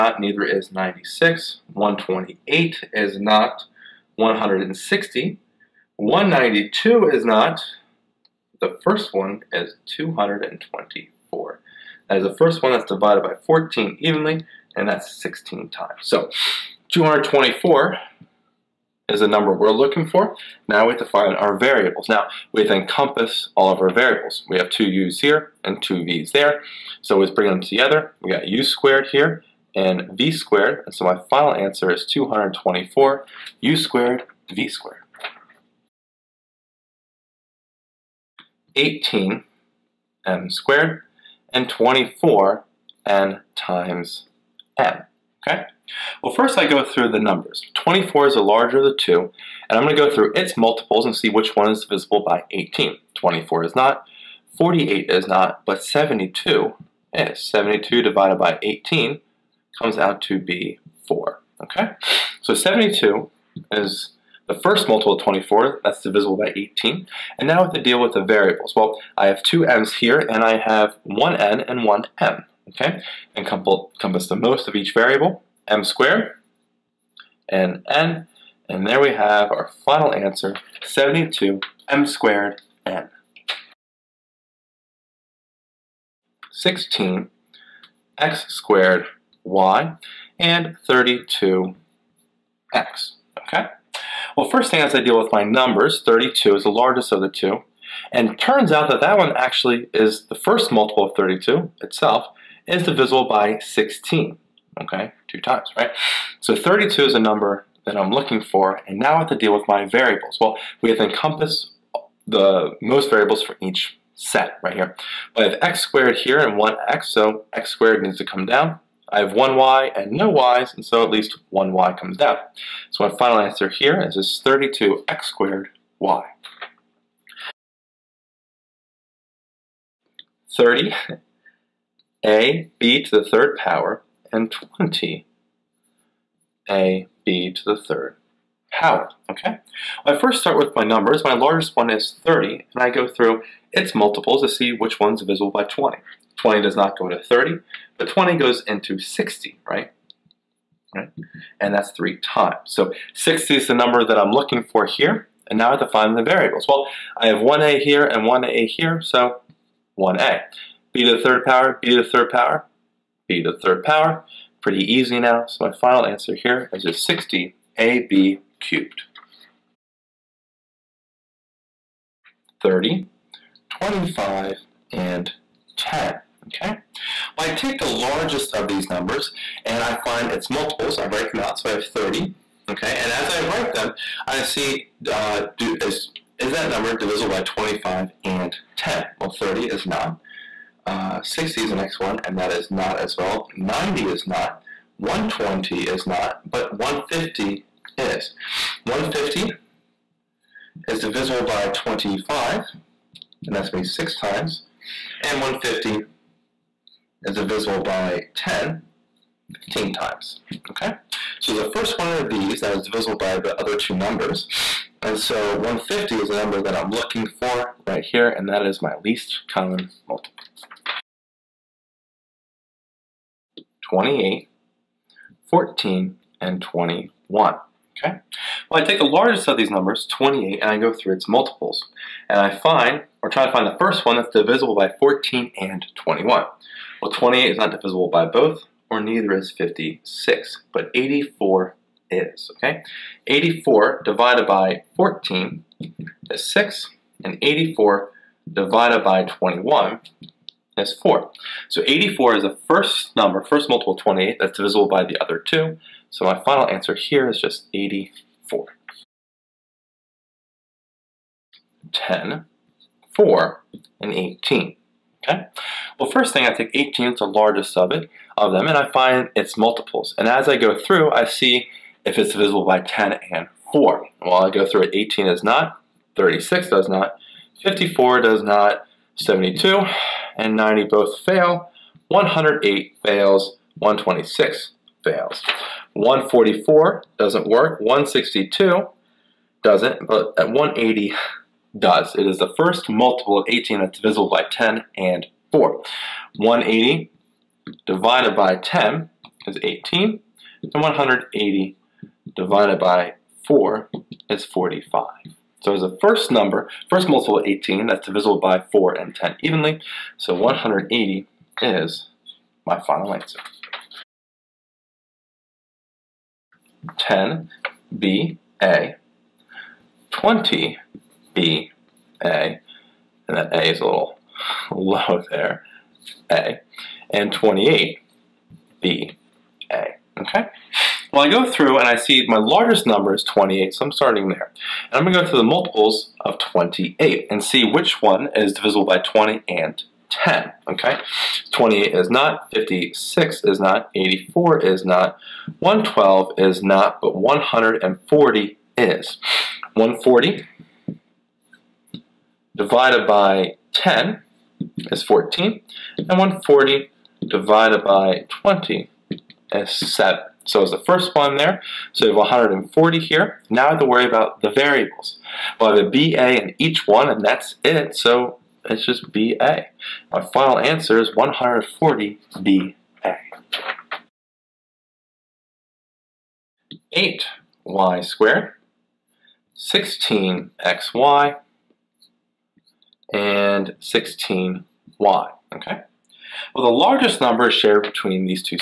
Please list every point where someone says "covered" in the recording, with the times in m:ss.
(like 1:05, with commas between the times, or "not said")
not said.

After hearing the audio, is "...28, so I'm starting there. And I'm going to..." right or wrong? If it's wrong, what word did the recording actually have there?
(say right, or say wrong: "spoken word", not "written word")
right.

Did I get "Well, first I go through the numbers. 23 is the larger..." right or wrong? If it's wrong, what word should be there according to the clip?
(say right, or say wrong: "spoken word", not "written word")
wrong: "24", not "23".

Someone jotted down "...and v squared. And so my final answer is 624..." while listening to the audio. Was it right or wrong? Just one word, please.
wrong.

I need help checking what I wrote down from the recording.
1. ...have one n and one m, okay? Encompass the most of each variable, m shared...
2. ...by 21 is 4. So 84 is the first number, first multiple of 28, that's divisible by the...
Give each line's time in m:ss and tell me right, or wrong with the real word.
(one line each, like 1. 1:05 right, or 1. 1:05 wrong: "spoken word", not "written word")
1. 1:10 wrong: "squared", not "shared"
2. 4:09 right.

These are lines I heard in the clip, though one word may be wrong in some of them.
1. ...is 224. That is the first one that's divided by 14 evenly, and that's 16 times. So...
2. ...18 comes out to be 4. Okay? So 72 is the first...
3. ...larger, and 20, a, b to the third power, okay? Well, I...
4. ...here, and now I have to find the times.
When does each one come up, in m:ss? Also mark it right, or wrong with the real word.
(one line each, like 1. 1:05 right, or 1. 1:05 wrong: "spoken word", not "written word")
1. 0:09 right
2. 0:58 right
3. 2:13 wrong: "power", not "larger"
4. 2:34 wrong: "variables", not "times".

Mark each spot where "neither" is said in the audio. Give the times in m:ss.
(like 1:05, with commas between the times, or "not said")
0:00, 3:58.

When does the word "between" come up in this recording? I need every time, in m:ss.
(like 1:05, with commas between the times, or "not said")
6:27.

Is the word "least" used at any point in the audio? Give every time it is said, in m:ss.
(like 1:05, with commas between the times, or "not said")
2:01, 3:39.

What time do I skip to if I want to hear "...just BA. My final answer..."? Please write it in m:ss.
6:08.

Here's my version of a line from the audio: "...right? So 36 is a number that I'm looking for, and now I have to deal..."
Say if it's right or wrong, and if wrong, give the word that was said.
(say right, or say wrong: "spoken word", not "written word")
wrong: "32", not "36".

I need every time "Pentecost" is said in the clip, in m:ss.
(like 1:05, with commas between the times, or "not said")
not said.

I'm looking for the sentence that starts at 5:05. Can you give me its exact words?
So as a first number, first multiple 18, that's divisible by 4 and 10 evenly, so 180 is my final answer.